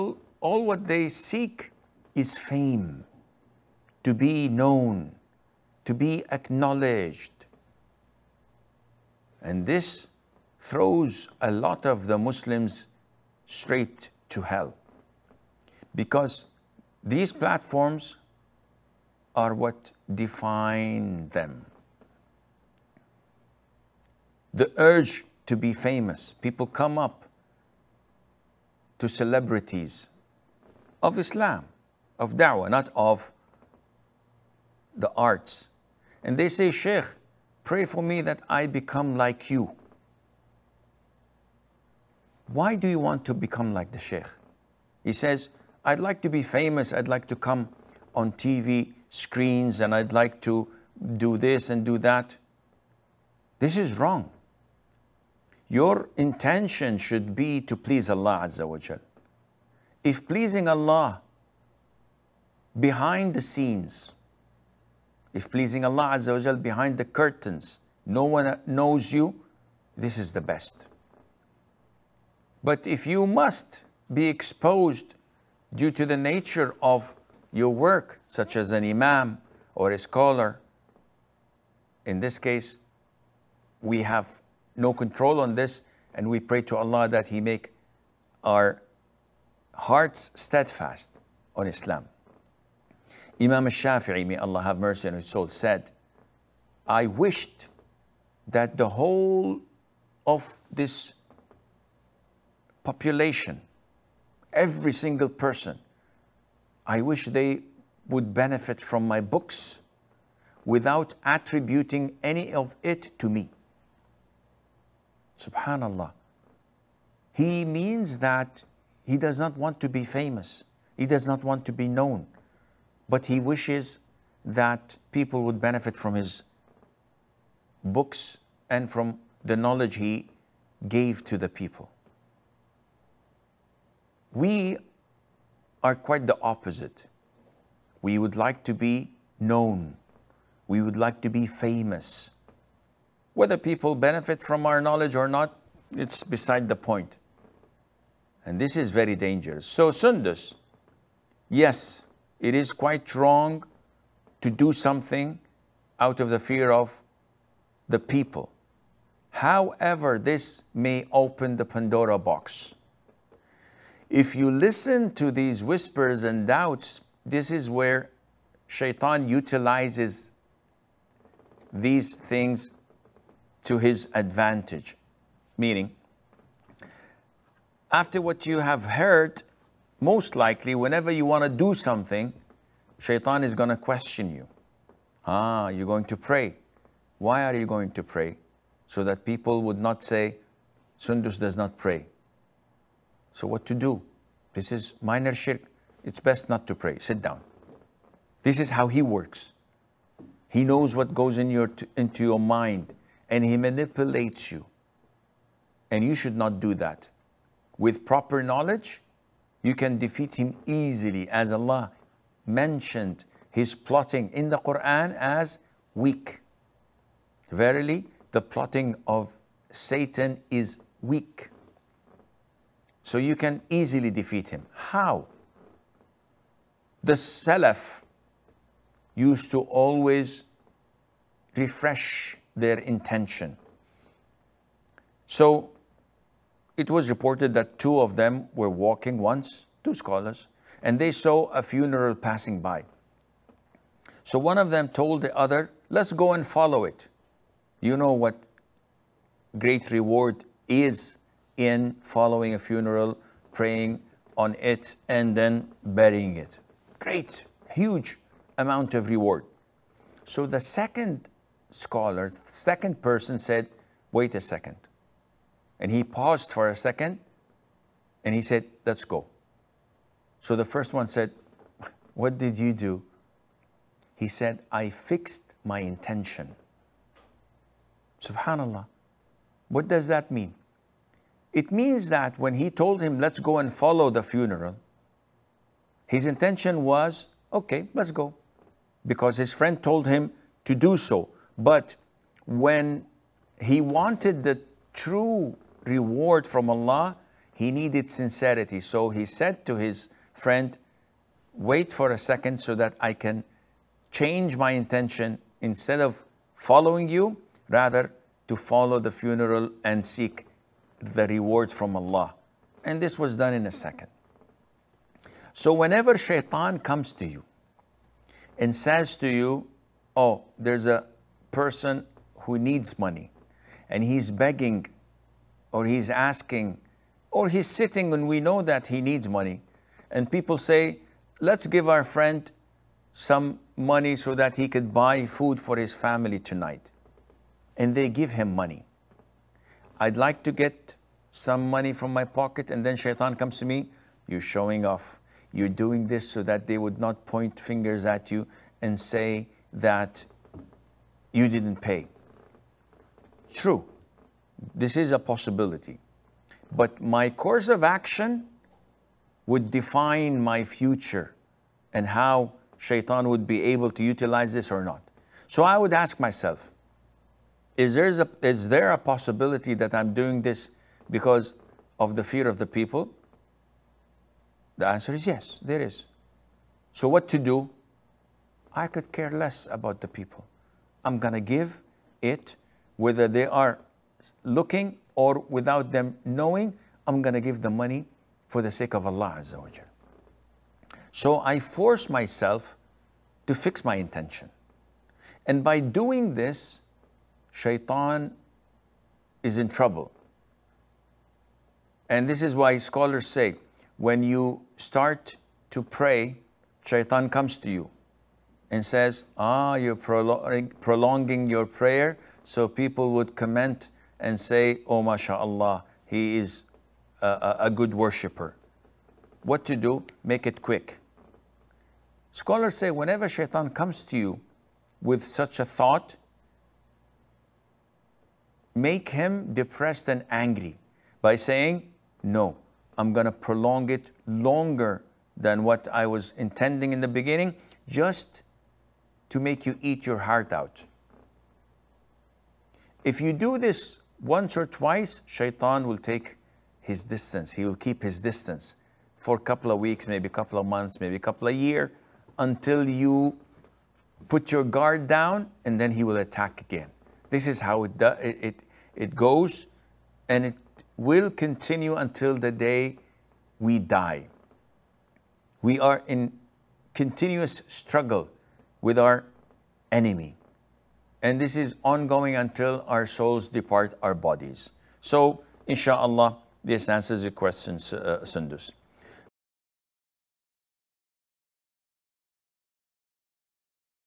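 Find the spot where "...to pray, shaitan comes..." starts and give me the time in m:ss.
6:45.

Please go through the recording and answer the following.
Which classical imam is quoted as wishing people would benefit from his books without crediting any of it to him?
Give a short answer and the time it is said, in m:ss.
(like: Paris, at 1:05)
Imam Shafii, at 1:33.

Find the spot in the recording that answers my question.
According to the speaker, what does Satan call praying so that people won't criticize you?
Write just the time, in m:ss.
3:15.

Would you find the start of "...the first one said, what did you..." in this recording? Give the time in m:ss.
4:30.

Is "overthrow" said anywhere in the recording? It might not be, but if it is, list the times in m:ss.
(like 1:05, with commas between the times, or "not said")
not said.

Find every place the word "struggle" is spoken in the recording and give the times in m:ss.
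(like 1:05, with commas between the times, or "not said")
7:47.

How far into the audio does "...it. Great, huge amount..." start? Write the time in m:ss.
4:16.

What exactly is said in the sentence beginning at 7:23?
If you do this once or twice, shaitan will take his distance.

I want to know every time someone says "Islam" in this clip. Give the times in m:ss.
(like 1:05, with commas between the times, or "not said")
0:31, 1:31.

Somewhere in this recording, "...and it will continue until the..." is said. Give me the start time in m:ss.
7:40.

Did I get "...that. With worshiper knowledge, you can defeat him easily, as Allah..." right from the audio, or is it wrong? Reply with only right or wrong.
wrong.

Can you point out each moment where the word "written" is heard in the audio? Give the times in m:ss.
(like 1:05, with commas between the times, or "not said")
not said.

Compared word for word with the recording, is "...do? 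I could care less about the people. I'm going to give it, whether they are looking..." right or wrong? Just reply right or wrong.
right.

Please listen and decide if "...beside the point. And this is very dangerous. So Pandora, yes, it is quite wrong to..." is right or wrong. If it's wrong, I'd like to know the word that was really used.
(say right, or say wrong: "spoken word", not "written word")
wrong: "Sundus", not "Pandora".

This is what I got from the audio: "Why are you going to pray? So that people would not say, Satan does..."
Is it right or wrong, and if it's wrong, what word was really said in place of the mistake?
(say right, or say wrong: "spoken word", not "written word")
wrong: "Sundus", not "Satan".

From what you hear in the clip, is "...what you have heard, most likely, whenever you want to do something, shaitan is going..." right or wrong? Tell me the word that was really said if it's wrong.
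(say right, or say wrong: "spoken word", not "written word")
right.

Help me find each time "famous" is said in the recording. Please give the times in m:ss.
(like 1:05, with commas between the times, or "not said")
0:25, 0:46, 2:00, 2:21.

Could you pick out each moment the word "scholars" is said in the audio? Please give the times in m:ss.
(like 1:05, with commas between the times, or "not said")
1:19, 3:59, 4:21, 6:42, 7:02.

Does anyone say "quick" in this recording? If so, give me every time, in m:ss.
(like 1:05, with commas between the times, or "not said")
7:00.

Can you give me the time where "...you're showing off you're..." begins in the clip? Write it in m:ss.
5:44.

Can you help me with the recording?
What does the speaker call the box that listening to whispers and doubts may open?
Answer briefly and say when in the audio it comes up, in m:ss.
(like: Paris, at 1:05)
Pandora box, at 2:41.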